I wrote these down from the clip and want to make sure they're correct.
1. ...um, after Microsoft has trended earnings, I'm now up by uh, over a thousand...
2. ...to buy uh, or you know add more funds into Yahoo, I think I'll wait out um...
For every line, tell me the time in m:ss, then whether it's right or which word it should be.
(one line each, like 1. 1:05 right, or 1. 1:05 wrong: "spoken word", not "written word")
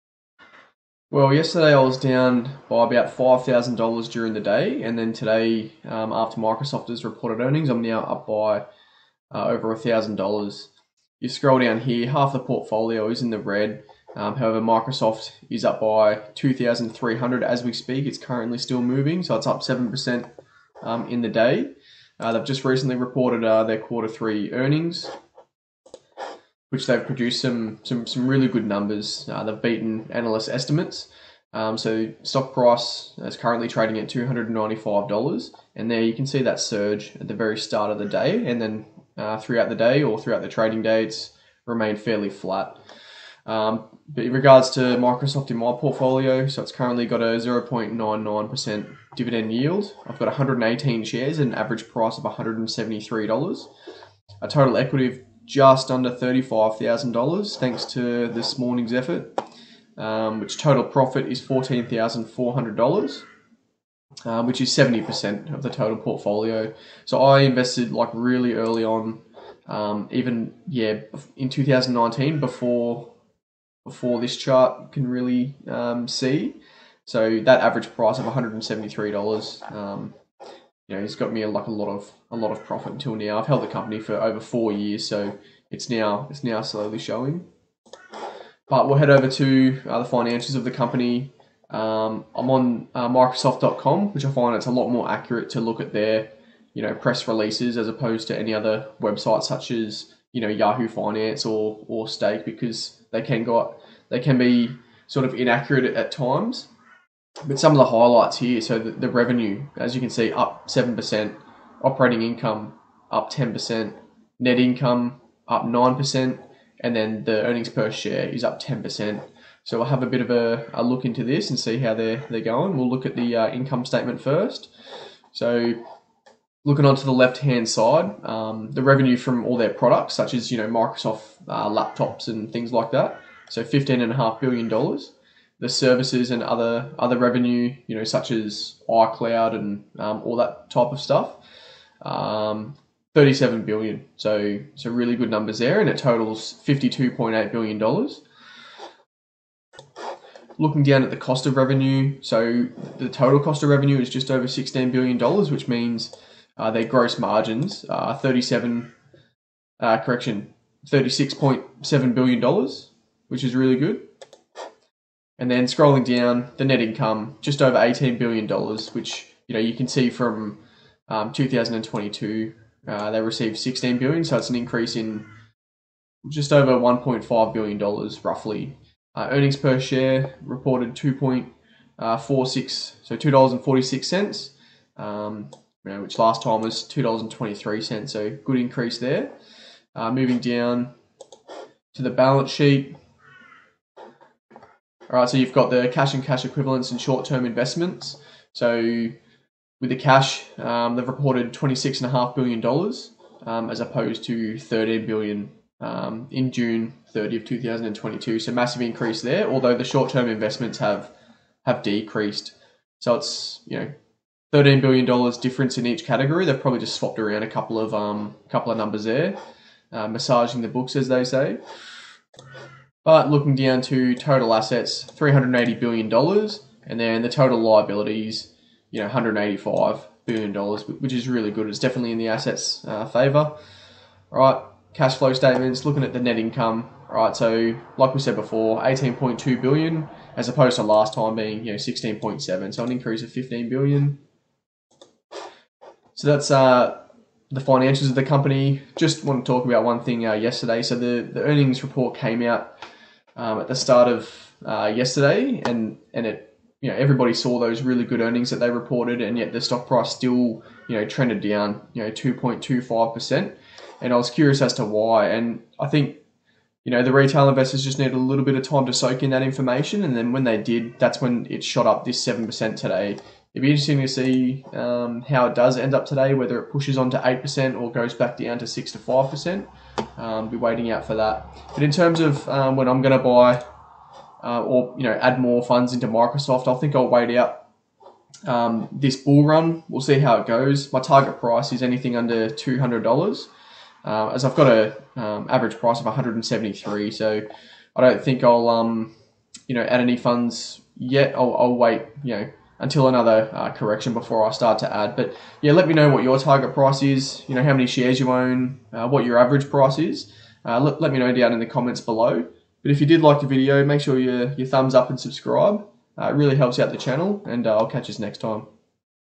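1. 0:05 wrong: "reported", not "trended"
2. 4:43 wrong: "Microsoft", not "Yahoo".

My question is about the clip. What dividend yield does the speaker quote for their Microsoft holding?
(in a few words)
0.99%.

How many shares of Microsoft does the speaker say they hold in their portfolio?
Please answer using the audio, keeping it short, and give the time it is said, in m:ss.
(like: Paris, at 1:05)
118, at 0:50.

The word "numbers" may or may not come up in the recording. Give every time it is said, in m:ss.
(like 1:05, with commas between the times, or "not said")
0:28, 2:25, 3:38.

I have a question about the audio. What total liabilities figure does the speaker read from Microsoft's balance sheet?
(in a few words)
$185 billion.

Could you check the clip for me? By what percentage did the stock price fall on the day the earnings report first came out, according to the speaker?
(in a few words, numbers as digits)
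2.25%.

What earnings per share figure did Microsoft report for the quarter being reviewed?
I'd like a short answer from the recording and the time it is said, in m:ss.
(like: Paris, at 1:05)
$2.46, at 3:03.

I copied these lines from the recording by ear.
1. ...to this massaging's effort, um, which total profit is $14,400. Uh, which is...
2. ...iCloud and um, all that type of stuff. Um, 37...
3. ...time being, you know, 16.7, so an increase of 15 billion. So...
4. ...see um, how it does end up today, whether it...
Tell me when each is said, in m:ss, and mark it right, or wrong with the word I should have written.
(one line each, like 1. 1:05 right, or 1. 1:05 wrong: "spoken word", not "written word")
1. 0:57 wrong: "morning", not "massaging"
2. 2:18 right
3. 4:01 right
4. 4:34 right.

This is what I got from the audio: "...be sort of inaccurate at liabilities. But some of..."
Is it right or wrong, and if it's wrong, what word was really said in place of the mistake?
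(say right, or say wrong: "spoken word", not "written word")
wrong: "times", not "liabilities".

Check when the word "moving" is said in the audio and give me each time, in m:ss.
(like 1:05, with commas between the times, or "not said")
0:18, 3:10.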